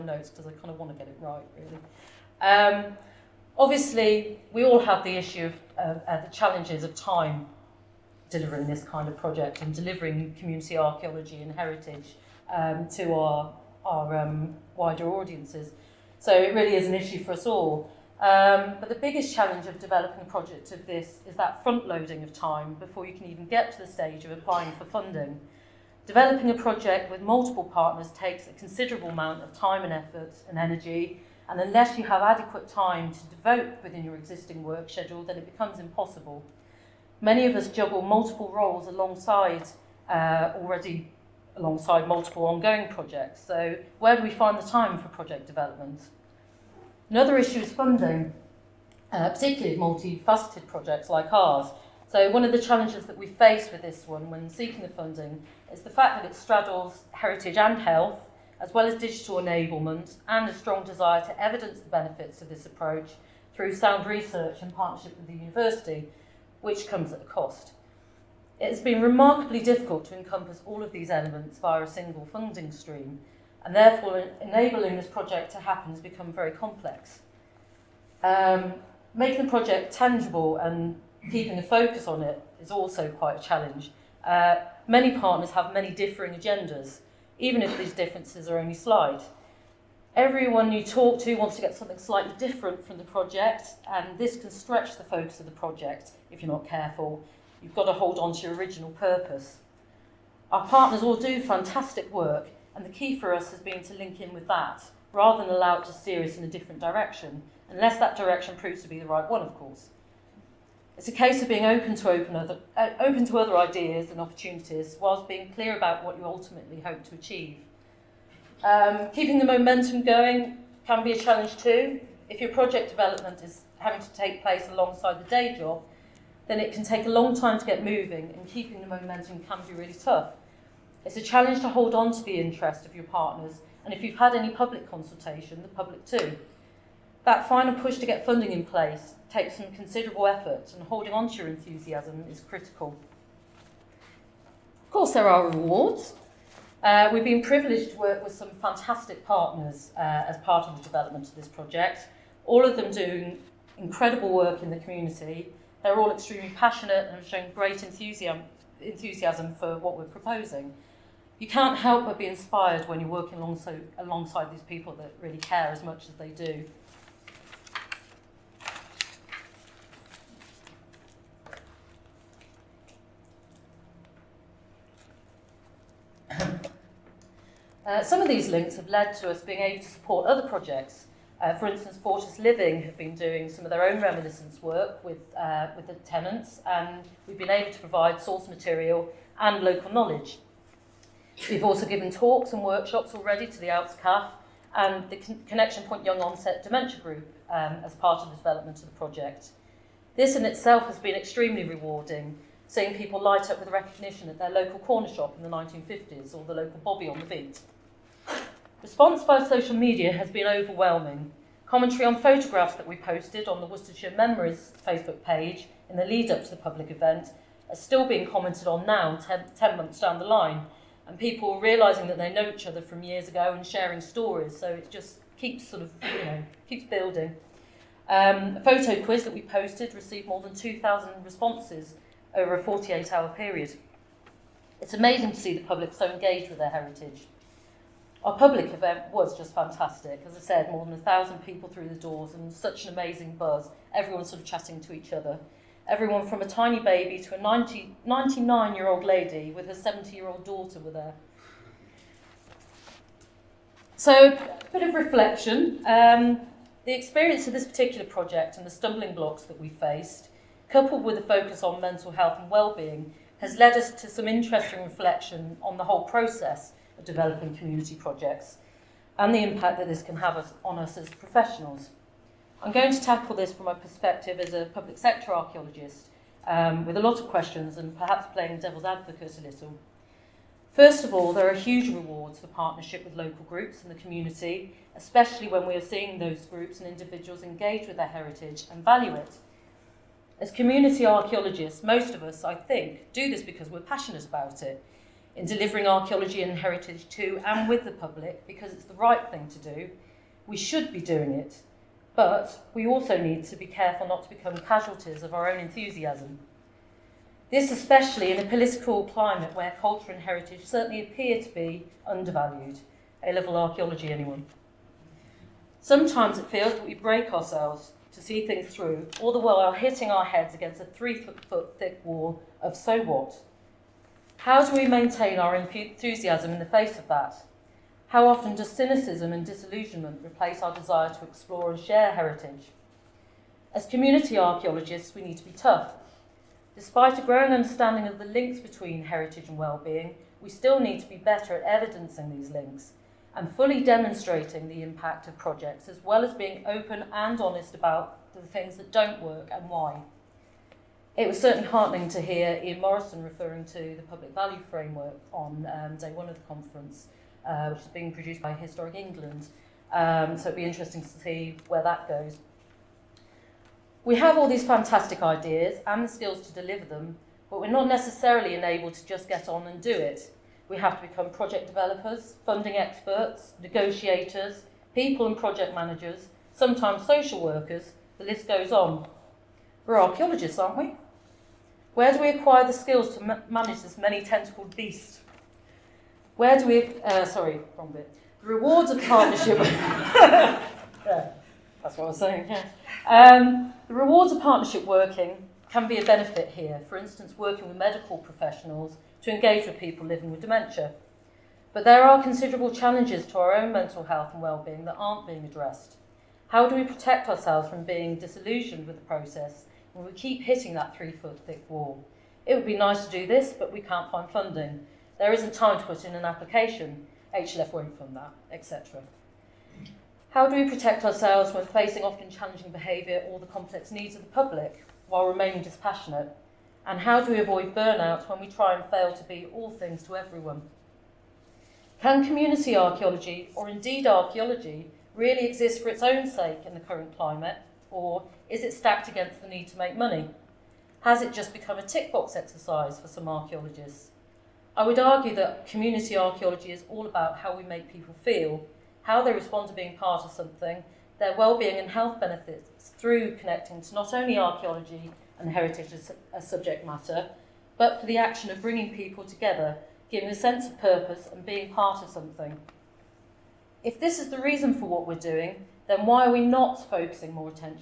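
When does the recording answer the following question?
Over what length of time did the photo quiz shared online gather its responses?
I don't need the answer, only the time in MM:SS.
03:52.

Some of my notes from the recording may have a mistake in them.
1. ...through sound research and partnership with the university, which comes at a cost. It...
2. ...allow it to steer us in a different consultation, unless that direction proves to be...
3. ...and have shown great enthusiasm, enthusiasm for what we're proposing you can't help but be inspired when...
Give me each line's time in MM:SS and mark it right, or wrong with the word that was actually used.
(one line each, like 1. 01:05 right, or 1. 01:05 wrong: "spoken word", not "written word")
1. 01:03 right
2. 01:45 wrong: "direction", not "consultation"
3. 02:37 right.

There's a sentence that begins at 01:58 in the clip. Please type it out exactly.
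Um, keeping the momentum going can be a challenge too.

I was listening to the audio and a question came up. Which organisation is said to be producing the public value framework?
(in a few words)
Historic England.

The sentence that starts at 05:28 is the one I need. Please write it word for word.
How often does cynicism and disillusionment replace our desire to explore and share heritage?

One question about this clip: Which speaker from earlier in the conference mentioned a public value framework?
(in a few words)
Ian Morrison.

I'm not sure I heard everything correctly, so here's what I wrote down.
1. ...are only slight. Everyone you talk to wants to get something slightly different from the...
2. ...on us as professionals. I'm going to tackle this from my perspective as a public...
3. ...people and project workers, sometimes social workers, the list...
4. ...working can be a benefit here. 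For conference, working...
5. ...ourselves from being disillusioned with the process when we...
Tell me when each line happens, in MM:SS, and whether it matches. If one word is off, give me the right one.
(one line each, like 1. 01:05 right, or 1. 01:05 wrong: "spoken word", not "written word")
1. 01:28 right
2. 04:30 right
3. 06:14 wrong: "managers", not "workers"
4. 06:34 wrong: "instance", not "conference"
5. 06:47 right.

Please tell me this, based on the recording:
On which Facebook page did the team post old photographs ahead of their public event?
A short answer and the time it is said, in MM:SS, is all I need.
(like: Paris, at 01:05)
Worcestershire Memories, at 03:33.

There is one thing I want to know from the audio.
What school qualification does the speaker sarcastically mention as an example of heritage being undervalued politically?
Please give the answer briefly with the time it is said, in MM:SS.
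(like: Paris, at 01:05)
A level archaeology, at 05:13.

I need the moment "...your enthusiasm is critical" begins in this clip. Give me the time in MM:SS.
02:21.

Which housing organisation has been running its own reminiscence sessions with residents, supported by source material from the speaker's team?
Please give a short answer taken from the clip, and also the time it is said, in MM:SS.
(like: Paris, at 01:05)
Fortis Living, at 03:02.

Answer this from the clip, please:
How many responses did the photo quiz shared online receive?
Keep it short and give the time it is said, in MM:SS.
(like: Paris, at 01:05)
more than 2,000, at 03:50.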